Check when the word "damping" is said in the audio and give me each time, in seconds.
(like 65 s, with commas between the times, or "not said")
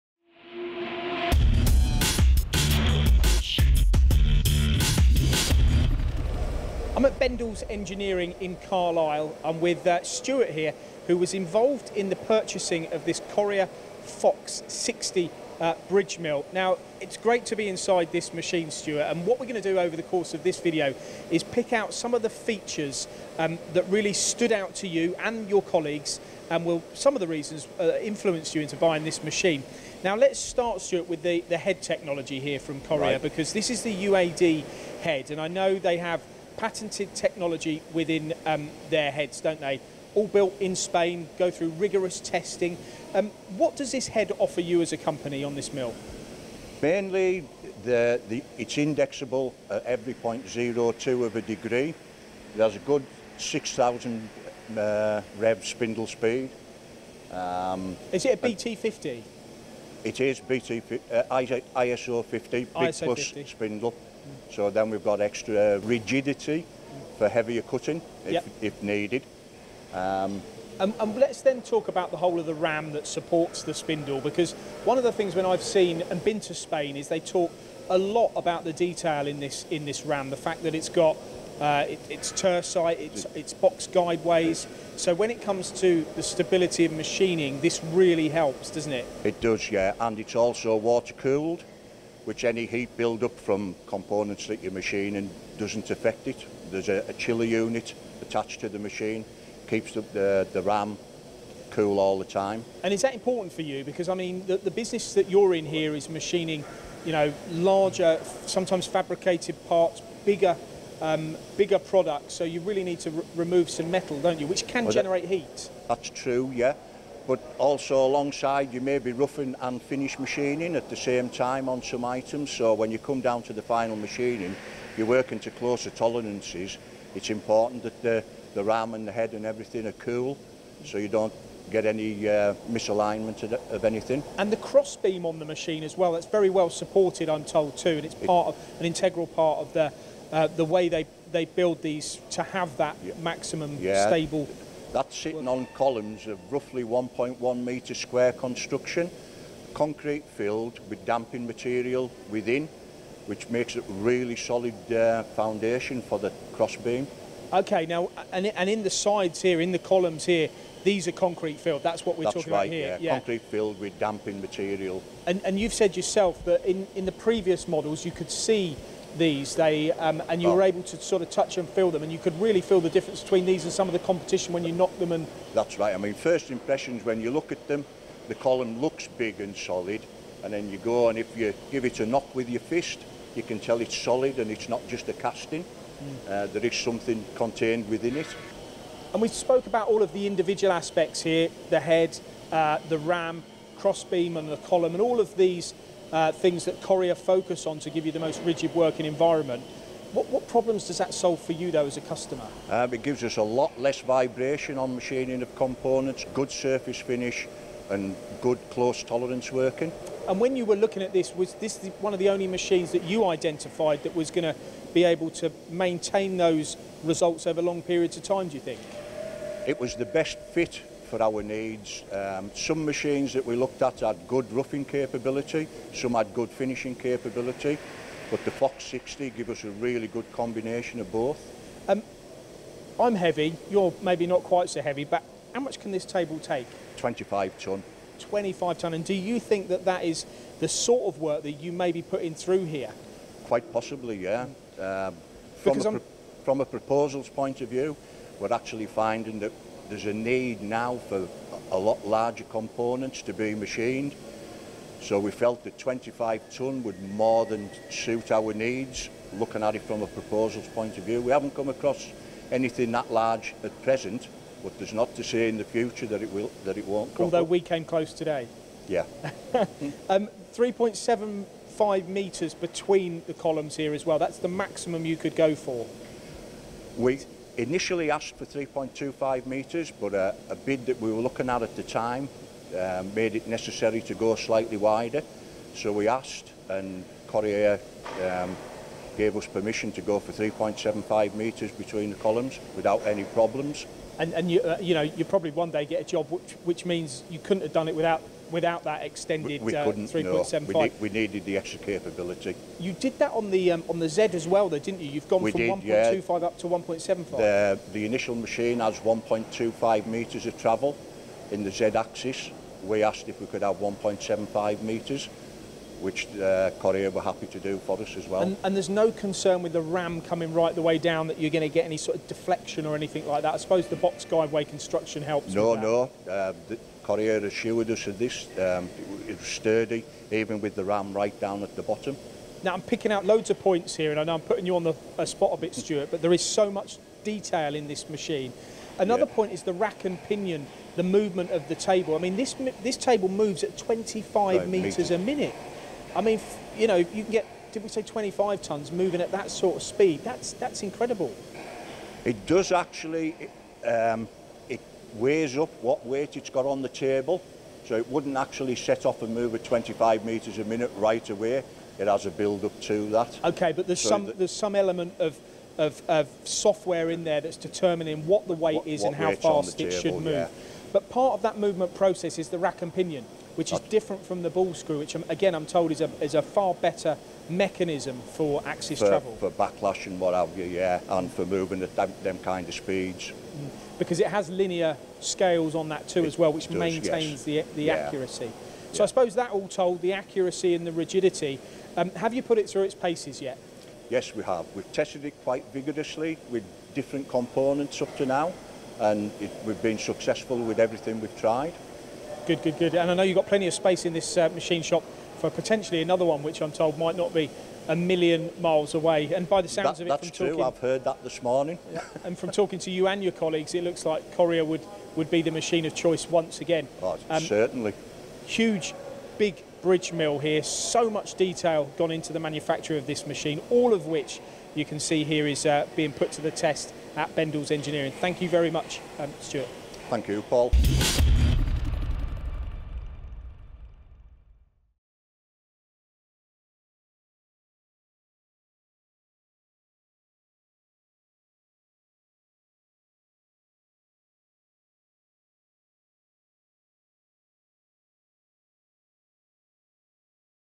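151 s, 163 s.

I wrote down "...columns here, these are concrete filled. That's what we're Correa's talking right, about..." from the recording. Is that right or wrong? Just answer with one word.
wrong.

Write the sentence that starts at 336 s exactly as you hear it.
But there is so much detail in this machine.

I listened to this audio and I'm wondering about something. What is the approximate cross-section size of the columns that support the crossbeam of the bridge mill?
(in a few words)
1.1 metre square.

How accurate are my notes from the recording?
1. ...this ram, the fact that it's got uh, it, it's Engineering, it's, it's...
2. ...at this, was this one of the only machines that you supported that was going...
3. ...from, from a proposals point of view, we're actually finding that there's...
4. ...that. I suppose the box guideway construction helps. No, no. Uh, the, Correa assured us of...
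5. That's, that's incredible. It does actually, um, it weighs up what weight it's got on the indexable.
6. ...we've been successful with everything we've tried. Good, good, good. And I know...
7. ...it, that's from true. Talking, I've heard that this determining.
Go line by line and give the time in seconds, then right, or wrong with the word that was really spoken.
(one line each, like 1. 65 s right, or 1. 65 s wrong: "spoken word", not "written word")
1. 79 s wrong: "Turcite", not "Engineering"
2. 211 s wrong: "identified", not "supported"
3. 245 s right
4. 323 s right
5. 350 s wrong: "table", not "indexable"
6. 399 s right
7. 410 s wrong: "morning", not "determining".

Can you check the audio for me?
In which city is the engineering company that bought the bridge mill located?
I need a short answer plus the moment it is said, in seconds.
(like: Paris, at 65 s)
Carlisle, at 8 s.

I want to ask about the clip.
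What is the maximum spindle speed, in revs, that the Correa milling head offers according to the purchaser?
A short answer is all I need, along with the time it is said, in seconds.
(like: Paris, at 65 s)
6,000, at 53 s.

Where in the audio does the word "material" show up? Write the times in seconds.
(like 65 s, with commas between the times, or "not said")
151 s, 164 s.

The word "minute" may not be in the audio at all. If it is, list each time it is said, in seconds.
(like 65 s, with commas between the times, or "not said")
345 s, 360 s.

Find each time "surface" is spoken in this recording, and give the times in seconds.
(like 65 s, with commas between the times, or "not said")
206 s.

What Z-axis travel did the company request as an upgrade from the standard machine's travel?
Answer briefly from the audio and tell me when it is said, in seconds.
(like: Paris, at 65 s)
1.75 metres, at 313 s.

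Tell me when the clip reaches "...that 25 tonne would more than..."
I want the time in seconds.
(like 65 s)
255 s.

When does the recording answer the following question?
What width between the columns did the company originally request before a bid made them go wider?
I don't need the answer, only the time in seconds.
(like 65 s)
278 s.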